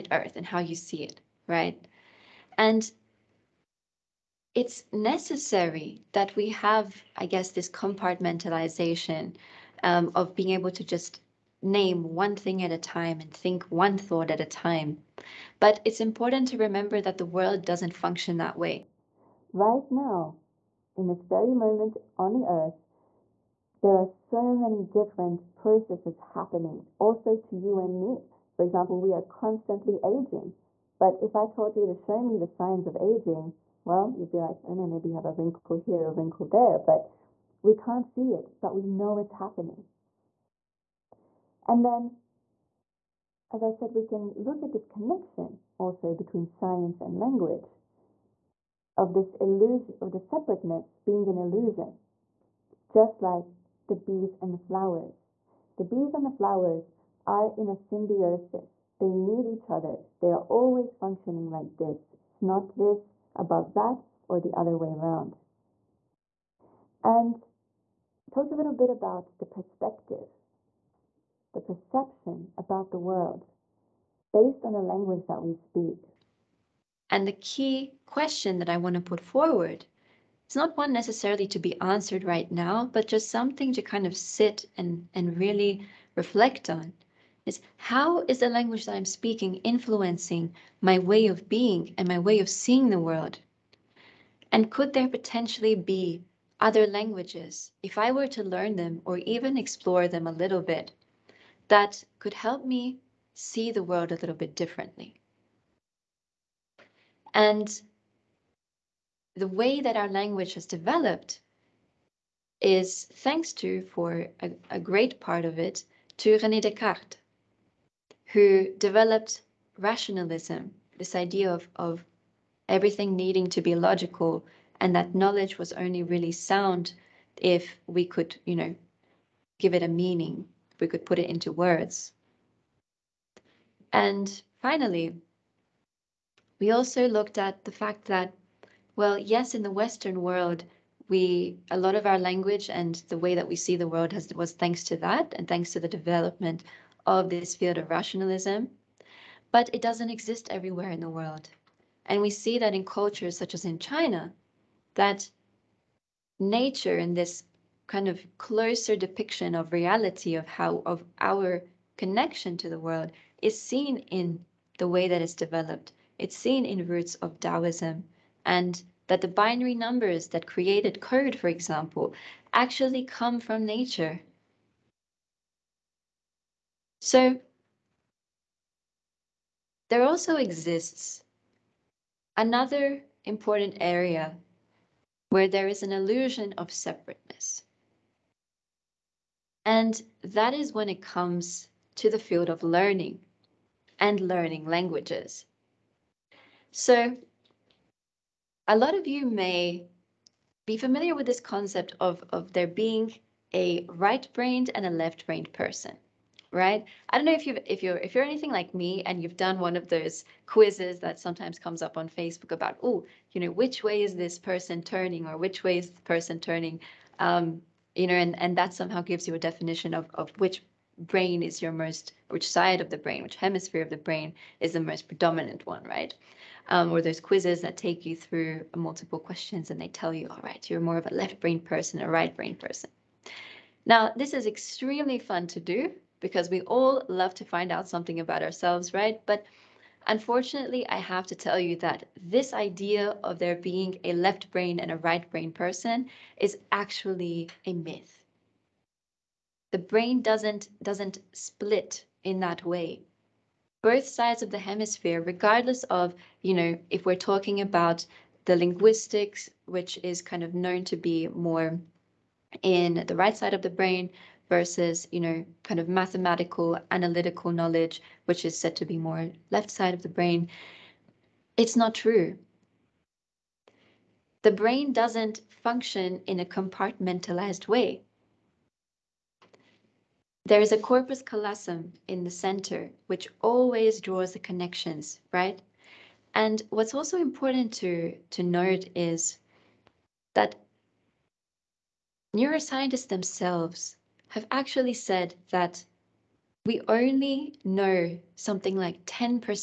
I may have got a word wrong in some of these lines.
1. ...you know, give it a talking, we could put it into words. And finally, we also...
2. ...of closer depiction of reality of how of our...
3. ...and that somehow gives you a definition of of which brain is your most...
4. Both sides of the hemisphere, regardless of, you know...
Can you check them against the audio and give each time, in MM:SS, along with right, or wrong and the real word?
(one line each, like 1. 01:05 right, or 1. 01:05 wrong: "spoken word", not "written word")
1. 02:08 wrong: "meaning", not "talking"
2. 02:38 right
3. 03:38 right
4. 04:13 right.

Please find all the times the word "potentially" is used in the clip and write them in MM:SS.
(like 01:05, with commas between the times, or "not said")
01:35.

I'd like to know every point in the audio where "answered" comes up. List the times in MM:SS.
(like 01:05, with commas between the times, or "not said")
01:21.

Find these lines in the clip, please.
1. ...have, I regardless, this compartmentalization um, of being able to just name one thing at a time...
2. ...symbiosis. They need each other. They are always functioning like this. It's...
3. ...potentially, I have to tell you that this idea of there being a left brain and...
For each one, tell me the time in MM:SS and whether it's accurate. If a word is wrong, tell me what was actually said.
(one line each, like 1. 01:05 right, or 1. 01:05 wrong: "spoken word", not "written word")
1. 00:06 wrong: "guess", not "regardless"
2. 00:57 right
3. 04:00 wrong: "unfortunately", not "potentially".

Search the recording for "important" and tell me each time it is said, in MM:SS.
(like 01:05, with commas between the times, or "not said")
00:15, 03:03, 04:47.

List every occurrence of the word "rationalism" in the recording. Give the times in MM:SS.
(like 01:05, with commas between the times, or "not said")
01:59, 02:27.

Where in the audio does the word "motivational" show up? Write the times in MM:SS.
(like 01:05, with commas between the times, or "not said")
not said.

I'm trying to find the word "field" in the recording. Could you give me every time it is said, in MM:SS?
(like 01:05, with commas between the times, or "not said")
02:27, 03:12.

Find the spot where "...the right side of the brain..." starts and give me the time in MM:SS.
04:23.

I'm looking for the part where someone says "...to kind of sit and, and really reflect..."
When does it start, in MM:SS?
01:23.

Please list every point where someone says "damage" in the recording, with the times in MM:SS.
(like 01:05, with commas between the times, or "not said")
not said.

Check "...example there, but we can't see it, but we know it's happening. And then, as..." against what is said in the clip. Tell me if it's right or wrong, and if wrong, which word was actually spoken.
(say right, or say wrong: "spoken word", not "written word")
wrong: "wrinkle", not "example".